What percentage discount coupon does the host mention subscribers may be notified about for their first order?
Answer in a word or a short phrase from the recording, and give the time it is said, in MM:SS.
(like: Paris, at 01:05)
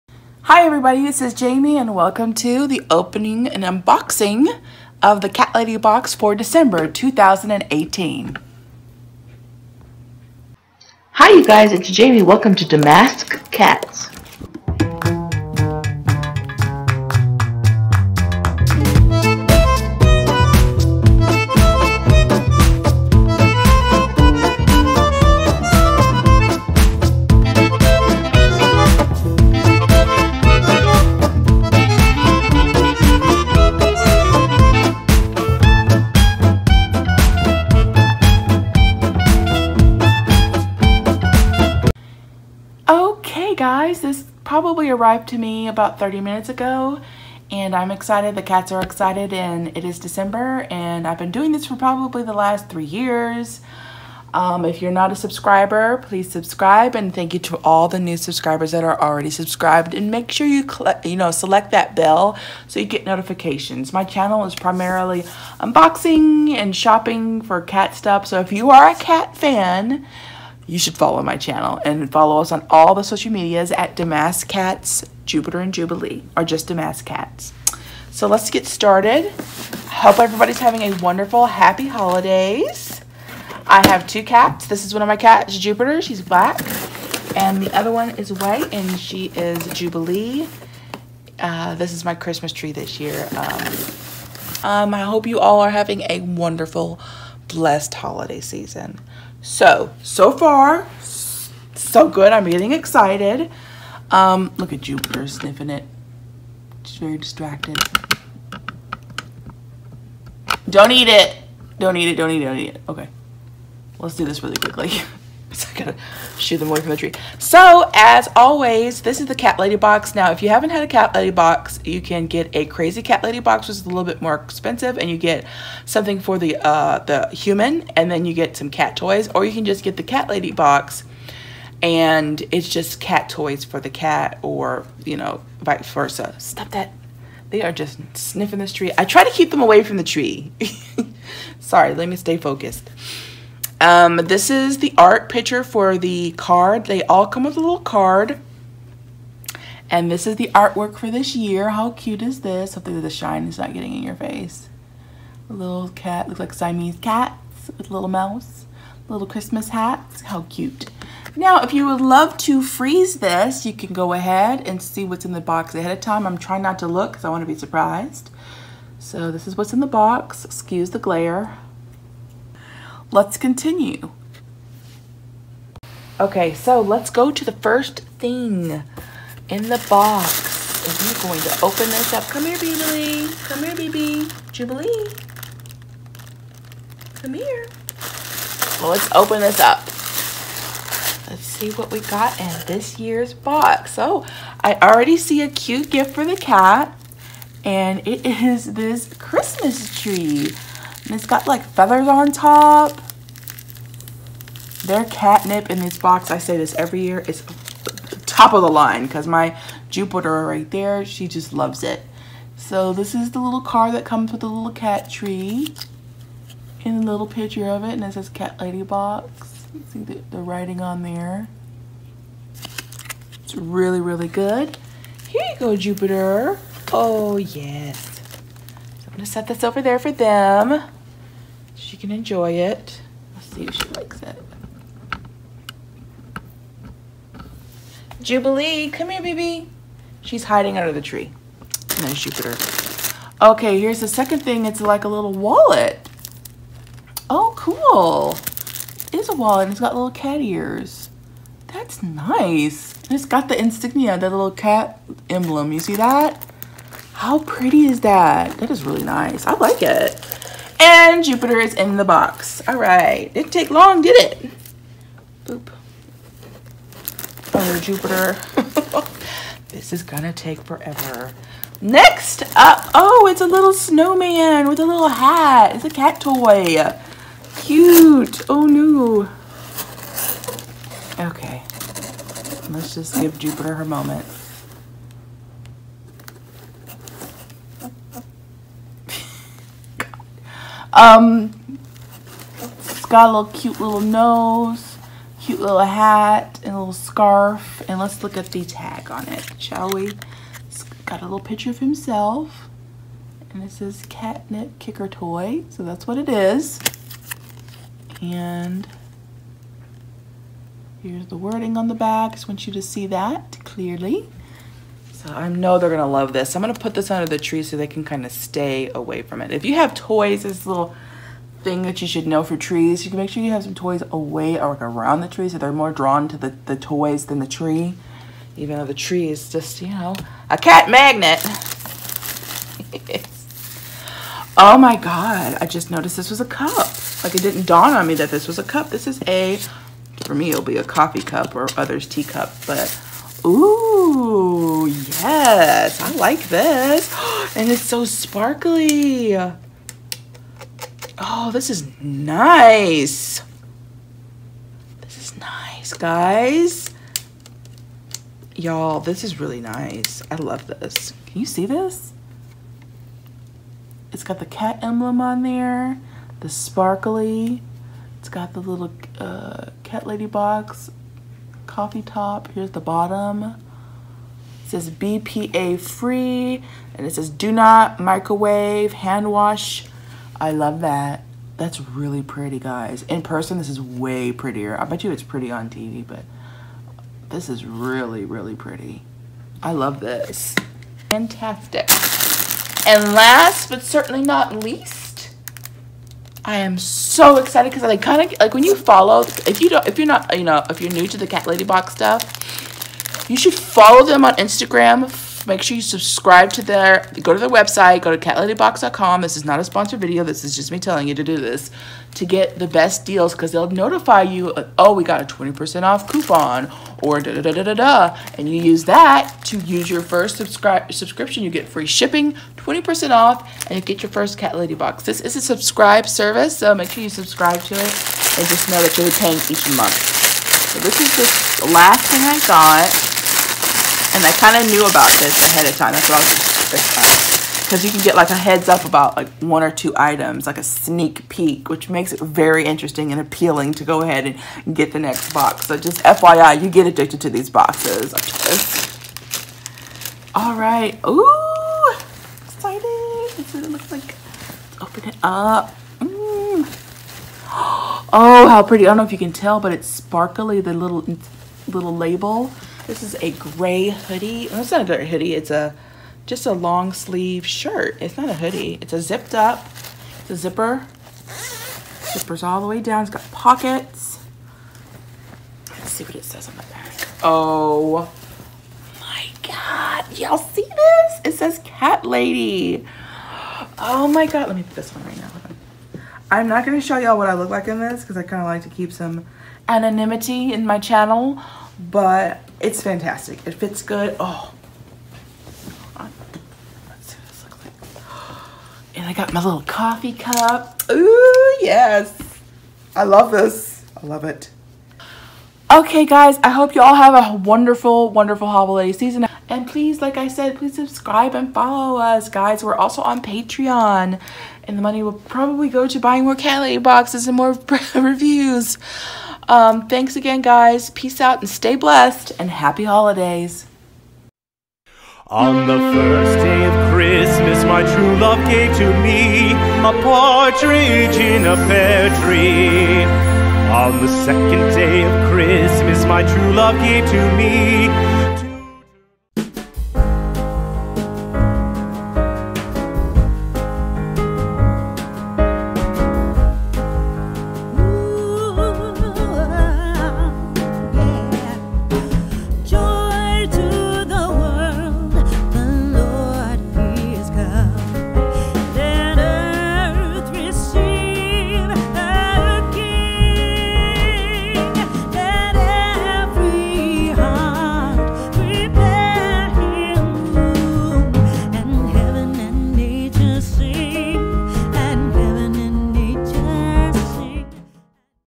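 20%, at 06:55.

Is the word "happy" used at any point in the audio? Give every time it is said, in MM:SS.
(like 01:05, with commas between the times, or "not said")
01:21, 08:42.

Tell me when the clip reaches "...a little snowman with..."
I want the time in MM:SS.
04:33.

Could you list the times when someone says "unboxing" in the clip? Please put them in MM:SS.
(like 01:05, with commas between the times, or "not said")
00:03, 01:05.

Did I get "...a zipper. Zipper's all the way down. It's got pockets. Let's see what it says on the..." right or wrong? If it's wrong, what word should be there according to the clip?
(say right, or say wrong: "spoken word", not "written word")
right.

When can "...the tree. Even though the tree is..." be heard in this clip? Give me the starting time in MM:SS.
05:27.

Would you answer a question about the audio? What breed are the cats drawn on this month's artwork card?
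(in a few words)
Siamese.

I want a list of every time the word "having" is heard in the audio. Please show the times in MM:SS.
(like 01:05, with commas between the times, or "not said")
01:20, 01:35.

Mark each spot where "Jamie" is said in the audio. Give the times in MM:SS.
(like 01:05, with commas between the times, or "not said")
00:01, 00:11.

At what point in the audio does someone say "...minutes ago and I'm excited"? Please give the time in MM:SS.
00:46.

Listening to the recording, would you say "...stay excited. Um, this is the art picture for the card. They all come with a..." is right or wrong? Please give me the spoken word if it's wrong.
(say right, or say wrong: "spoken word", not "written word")
wrong: "focused", not "excited".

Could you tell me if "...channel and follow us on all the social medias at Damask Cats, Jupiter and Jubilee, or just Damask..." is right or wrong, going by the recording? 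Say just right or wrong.
right.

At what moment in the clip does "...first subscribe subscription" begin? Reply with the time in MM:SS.
07:00.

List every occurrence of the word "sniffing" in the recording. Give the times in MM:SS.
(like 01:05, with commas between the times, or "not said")
01:45, 02:18.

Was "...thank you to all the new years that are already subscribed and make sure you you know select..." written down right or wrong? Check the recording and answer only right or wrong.
wrong.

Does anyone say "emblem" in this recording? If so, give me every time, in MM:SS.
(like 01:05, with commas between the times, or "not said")
04:15, 06:04.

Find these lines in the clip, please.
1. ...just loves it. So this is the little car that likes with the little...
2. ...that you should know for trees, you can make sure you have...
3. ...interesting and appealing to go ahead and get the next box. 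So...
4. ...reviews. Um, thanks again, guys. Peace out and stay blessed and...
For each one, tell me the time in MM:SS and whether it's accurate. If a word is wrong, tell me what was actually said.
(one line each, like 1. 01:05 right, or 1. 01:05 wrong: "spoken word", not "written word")
1. 03:31 wrong: "comes", not "likes"
2. 05:21 right
3. 07:22 right
4. 08:37 right.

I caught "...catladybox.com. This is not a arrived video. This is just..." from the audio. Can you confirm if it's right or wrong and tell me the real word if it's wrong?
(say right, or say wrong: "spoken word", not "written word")
wrong: "sponsored", not "arrived".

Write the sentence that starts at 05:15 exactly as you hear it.
So I know they're gonna love this.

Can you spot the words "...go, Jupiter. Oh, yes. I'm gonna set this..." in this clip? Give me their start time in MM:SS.
03:45.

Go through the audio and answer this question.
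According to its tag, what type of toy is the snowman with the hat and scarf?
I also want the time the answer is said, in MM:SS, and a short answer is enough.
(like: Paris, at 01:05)
catnip kicker toy, at 05:04.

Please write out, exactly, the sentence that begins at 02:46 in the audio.
I'm trying not to look because I want to be surprised.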